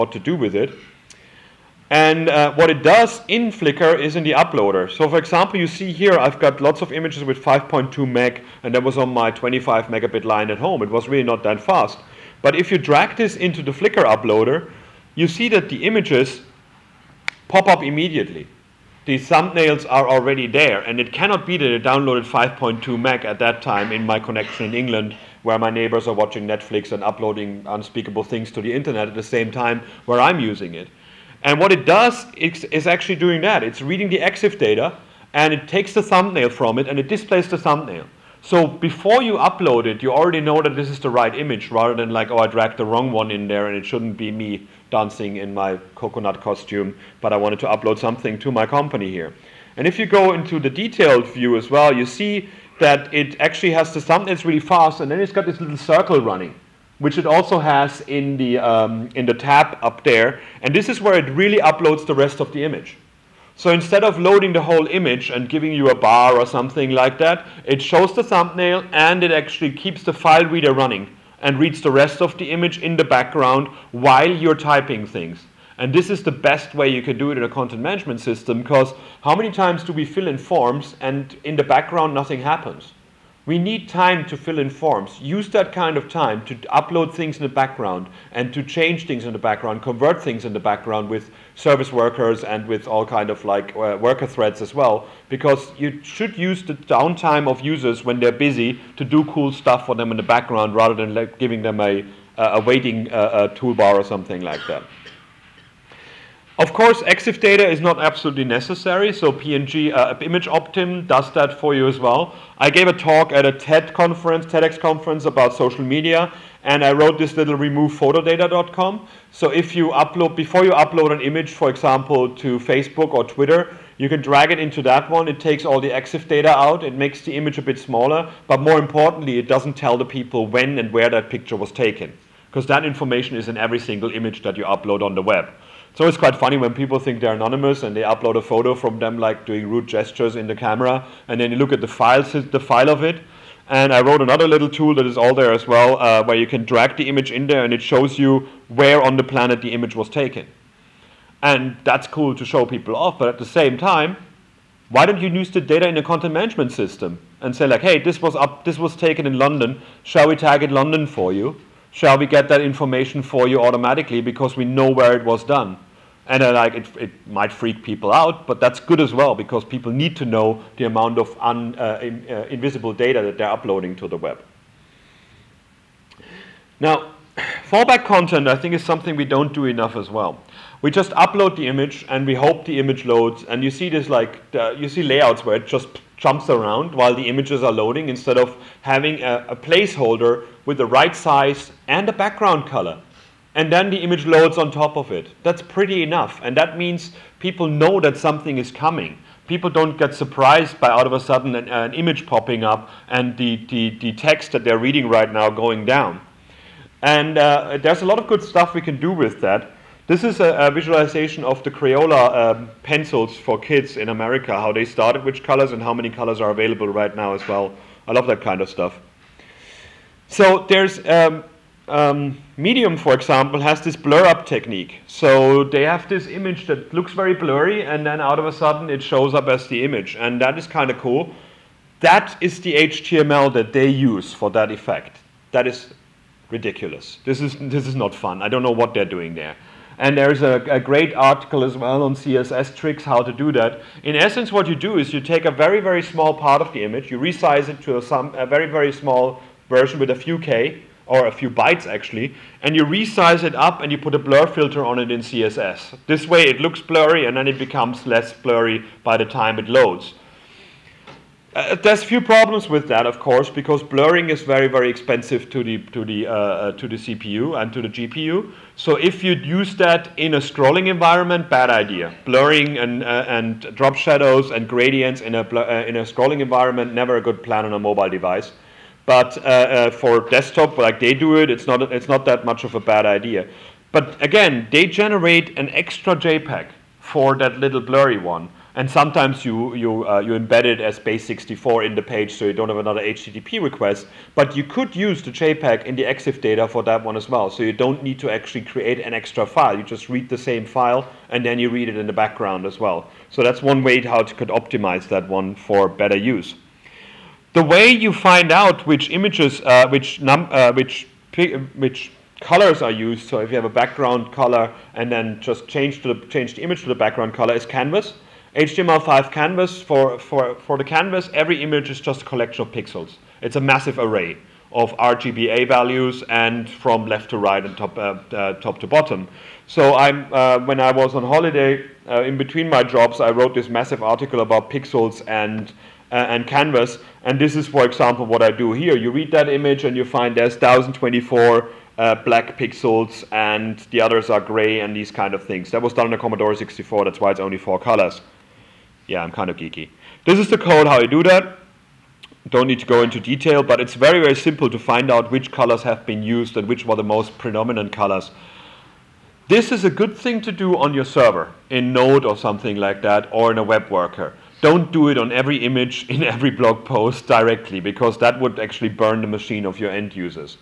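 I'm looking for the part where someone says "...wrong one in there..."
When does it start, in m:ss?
0:42.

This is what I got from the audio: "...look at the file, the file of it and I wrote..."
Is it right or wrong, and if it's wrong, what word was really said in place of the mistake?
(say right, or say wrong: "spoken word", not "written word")
right.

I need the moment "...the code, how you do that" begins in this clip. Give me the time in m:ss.
5:50.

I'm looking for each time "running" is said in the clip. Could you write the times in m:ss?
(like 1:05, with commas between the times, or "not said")
0:56, 1:10.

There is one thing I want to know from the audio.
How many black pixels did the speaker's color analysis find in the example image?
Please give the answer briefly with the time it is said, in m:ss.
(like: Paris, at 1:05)
1024, at 5:40.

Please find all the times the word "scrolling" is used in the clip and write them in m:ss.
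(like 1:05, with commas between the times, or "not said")
4:30, 4:36.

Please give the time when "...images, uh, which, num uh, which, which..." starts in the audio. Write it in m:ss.
5:09.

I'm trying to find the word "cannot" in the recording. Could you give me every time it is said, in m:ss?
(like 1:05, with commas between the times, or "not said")
0:21.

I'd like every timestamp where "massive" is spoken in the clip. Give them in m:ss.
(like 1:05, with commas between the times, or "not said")
5:23, 5:33.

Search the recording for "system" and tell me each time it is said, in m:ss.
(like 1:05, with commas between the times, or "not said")
1:18, 2:36.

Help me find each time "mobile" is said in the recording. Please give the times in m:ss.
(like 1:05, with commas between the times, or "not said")
4:37.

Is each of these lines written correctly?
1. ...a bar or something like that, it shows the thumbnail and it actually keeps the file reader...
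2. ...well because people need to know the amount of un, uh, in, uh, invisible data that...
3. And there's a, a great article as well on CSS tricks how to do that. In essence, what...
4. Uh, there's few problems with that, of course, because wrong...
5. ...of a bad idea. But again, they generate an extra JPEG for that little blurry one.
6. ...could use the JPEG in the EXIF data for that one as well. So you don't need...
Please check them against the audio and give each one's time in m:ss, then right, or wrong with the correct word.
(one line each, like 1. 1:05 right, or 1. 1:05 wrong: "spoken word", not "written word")
1. 1:05 right
2. 2:49 right
3. 3:59 right
4. 4:21 wrong: "blurring", not "wrong"
5. 4:42 right
6. 4:54 right.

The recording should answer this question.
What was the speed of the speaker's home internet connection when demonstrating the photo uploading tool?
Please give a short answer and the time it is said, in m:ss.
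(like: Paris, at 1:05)
25 megabit, at 0:09.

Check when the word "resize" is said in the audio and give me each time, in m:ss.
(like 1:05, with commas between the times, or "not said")
4:07, 4:12.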